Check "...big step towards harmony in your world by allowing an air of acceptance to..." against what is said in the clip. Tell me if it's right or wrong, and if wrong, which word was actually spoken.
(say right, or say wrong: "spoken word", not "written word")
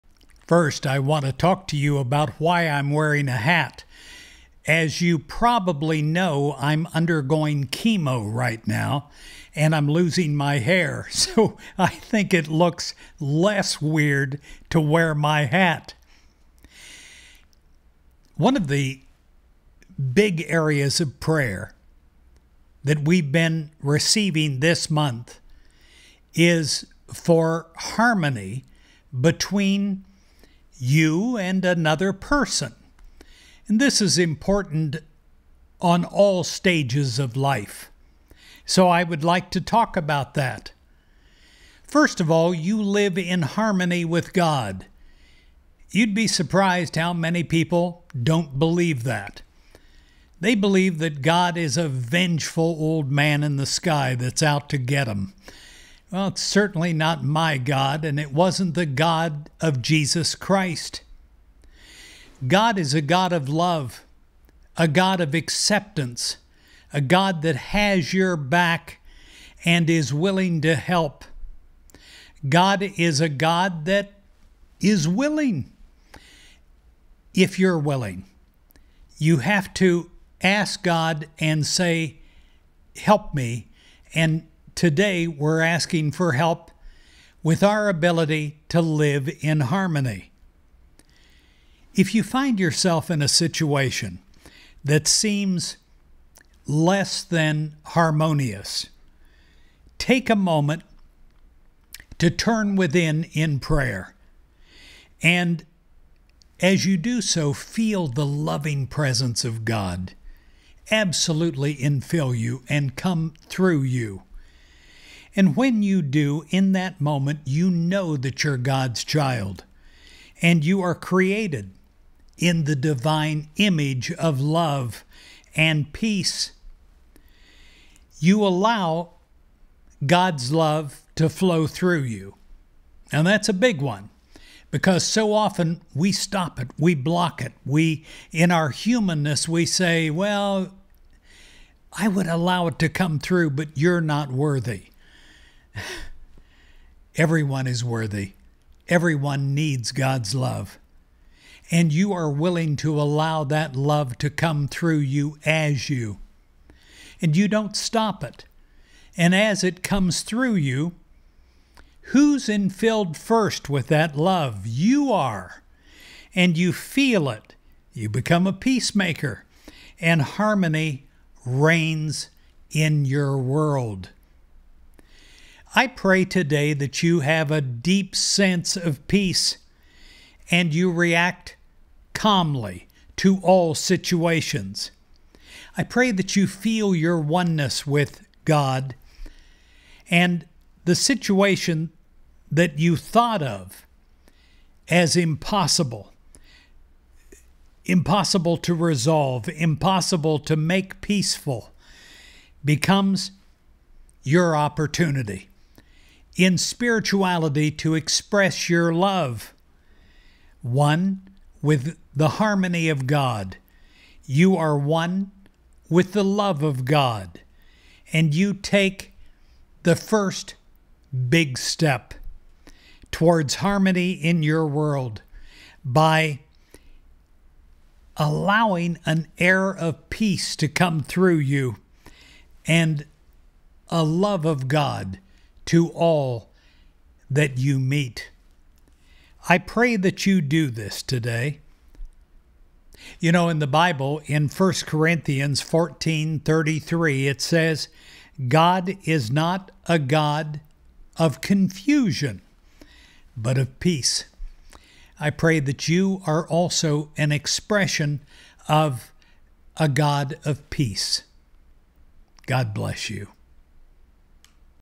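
wrong: "peace", not "acceptance".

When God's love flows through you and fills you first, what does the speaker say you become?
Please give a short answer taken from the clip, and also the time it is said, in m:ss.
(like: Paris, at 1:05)
peacemaker, at 2:48.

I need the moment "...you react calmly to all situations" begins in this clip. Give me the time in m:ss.
3:00.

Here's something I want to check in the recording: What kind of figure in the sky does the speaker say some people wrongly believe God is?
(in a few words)
vengeful old man.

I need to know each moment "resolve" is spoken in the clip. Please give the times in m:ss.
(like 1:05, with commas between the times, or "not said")
3:18.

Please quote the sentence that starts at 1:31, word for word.
If you find yourself in a situation that seems less than harmonious, take a moment to turn within in prayer.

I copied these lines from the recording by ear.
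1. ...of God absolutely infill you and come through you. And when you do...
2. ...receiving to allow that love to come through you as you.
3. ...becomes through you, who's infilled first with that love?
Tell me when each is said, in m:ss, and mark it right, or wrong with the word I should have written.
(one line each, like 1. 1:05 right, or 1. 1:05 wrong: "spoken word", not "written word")
1. 1:49 right
2. 2:32 wrong: "willing", not "receiving"
3. 2:39 wrong: "comes", not "becomes".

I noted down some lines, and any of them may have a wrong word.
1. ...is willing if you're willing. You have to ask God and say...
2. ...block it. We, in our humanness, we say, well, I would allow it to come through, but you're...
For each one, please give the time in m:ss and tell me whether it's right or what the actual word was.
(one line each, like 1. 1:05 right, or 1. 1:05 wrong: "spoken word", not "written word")
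1. 1:14 right
2. 2:16 right.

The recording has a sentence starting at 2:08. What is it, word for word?
You allow God's love to flow through you.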